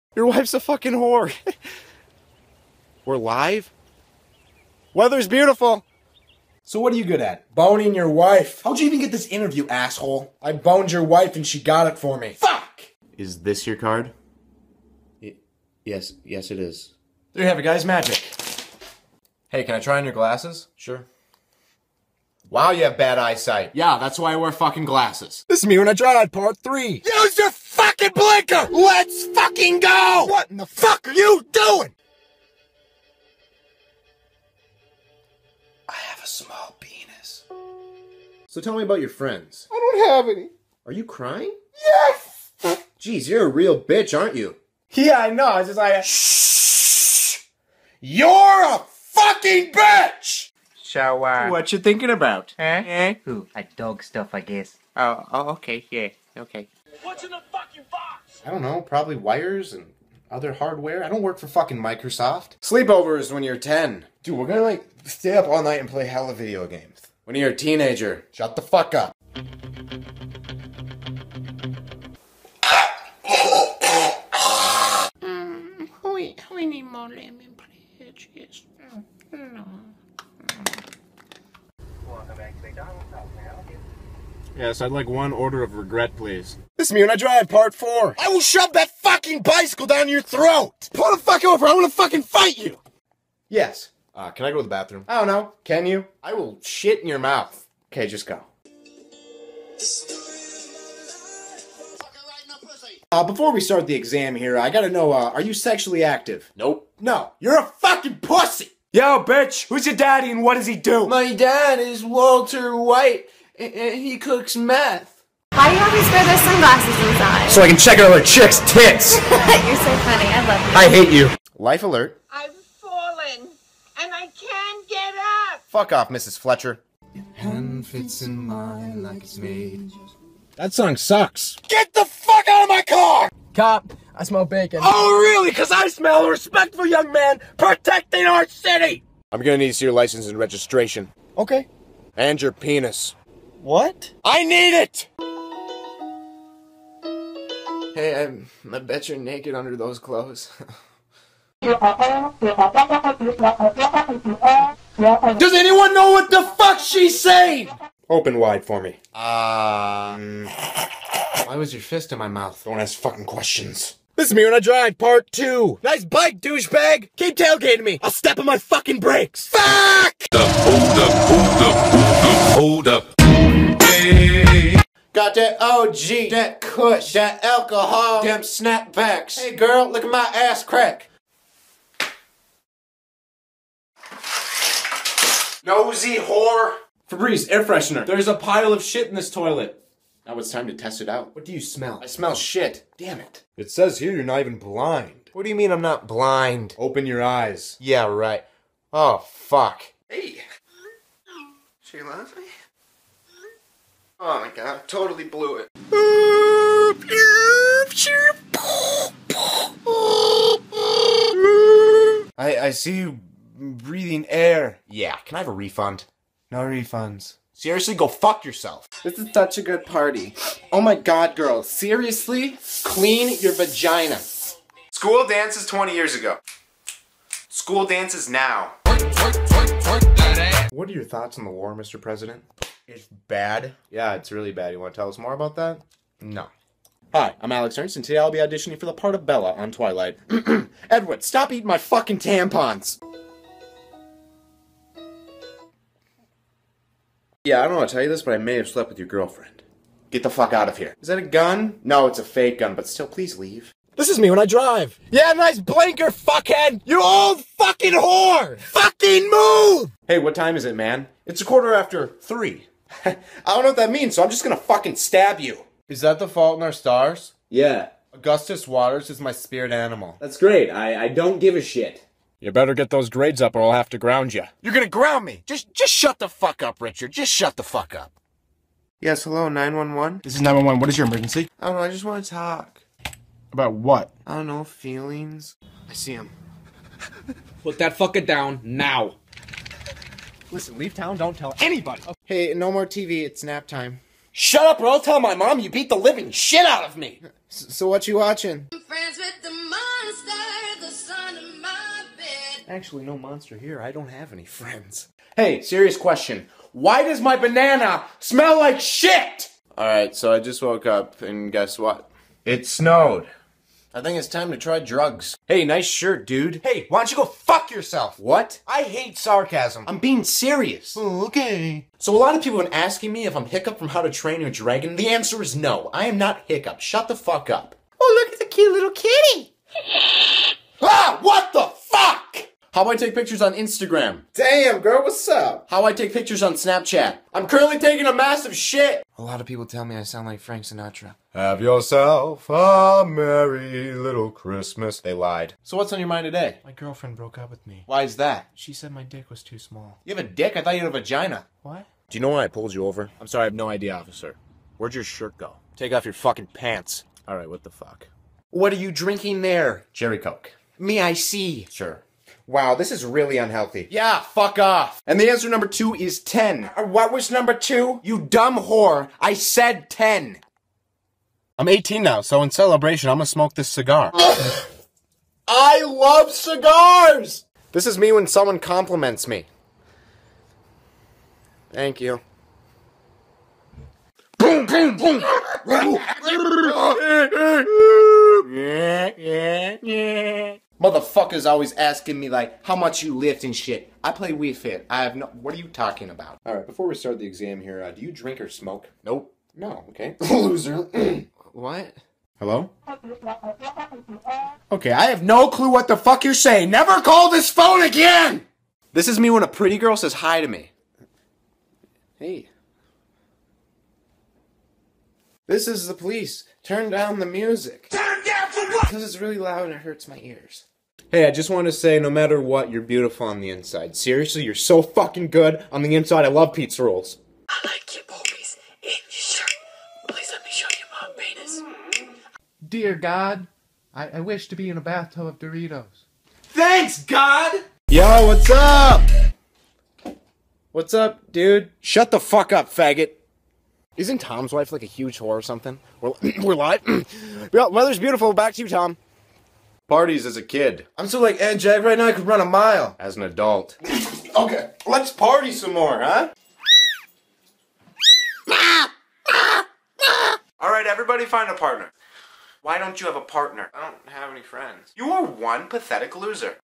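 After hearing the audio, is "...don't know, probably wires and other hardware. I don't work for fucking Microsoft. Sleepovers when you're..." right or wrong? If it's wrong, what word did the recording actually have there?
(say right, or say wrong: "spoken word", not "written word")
right.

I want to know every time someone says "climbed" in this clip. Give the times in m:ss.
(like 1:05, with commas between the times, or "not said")
not said.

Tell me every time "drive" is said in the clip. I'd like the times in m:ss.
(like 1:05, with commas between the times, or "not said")
1:27, 2:44, 4:14.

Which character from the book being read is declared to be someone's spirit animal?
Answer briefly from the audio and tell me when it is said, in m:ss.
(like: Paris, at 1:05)
Augustus Waters, at 4:28.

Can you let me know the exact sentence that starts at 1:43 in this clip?
Uh, before we start the exam here, I gotta know, uh, are you sexually active?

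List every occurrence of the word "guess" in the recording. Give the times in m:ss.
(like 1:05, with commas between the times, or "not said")
0:54, 5:11.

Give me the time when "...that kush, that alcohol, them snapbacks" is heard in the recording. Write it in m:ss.
2:56.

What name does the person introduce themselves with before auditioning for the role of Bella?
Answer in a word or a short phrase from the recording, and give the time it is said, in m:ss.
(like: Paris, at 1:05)
Alex Ernst, at 3:57.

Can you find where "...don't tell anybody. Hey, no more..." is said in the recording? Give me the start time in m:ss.
4:51.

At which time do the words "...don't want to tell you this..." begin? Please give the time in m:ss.
4:07.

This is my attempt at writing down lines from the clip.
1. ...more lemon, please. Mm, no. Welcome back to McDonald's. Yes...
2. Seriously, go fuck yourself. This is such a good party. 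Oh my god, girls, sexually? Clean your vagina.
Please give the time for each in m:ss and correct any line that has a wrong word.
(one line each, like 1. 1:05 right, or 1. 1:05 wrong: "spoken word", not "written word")
1. 1:16 right
2. 3:37 wrong: "seriously", not "sexually".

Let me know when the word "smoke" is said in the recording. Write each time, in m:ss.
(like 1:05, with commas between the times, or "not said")
6:13, 6:38.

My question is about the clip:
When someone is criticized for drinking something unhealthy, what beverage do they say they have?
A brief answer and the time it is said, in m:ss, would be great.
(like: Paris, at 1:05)
Cherry Coke, at 5:59.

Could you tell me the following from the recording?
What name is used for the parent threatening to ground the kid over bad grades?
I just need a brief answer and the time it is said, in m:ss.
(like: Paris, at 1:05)
Richard, at 4:36.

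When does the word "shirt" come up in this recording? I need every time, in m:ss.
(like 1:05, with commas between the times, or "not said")
5:15, 5:55, 7:09.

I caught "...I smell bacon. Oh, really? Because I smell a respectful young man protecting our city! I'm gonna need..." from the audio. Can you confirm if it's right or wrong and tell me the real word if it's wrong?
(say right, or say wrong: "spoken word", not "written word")
right.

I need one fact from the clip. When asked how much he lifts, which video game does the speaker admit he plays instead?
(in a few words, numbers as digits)
Wii Fit.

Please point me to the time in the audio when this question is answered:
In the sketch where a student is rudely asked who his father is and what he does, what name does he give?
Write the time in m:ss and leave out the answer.
1:52.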